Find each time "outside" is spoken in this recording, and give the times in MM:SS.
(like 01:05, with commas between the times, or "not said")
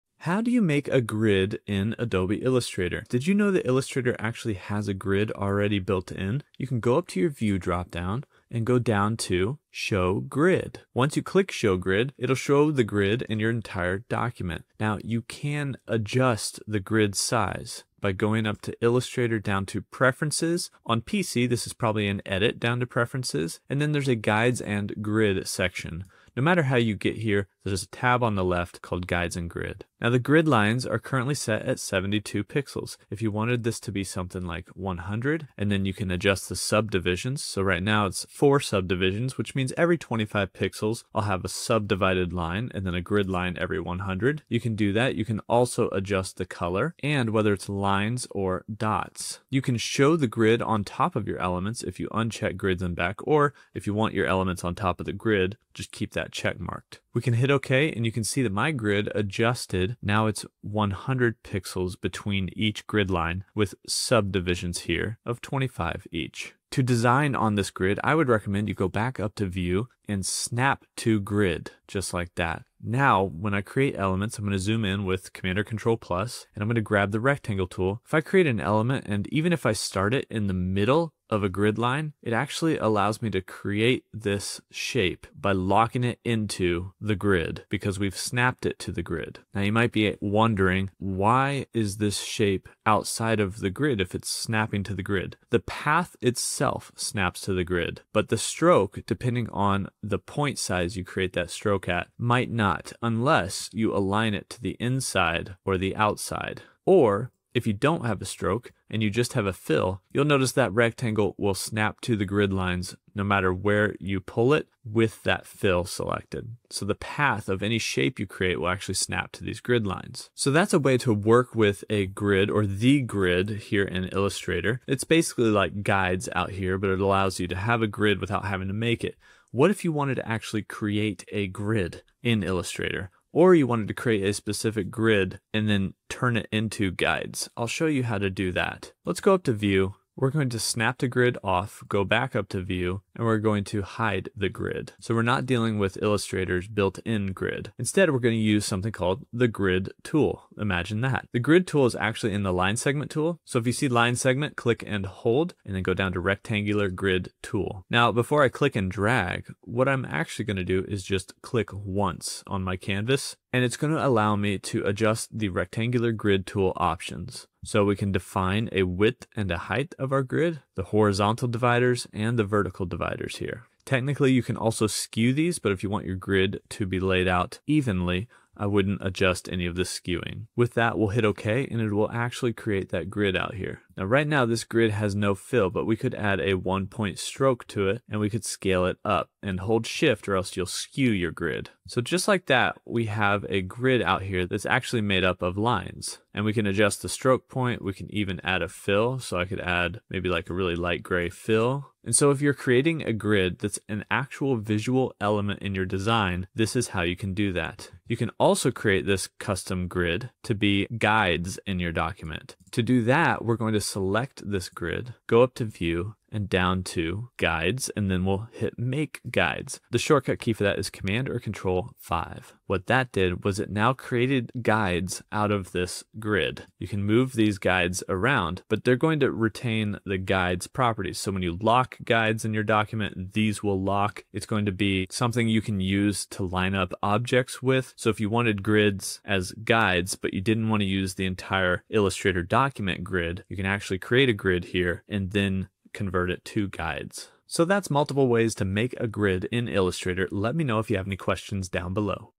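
01:32, 01:45.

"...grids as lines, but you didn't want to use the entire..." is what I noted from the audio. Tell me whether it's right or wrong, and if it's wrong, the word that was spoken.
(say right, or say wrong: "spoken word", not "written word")
wrong: "guides", not "lines".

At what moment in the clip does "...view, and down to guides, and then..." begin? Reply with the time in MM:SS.
03:35.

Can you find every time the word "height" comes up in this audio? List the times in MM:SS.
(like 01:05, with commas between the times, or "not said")
02:49.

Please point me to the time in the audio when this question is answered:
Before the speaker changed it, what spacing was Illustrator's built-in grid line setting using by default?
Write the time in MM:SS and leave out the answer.
00:31.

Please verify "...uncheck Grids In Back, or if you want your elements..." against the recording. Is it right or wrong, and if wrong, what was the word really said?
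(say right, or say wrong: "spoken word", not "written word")
right.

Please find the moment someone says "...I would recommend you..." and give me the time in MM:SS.
01:08.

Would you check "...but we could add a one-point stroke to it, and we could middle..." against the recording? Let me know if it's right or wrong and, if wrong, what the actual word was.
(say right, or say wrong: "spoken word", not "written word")
wrong: "scale", not "middle".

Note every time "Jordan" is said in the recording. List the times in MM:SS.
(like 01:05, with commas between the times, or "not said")
not said.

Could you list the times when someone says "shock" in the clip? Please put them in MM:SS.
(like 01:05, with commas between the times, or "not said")
not said.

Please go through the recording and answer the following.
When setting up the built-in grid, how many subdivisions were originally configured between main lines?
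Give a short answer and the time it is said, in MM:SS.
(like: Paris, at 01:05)
4, at 00:38.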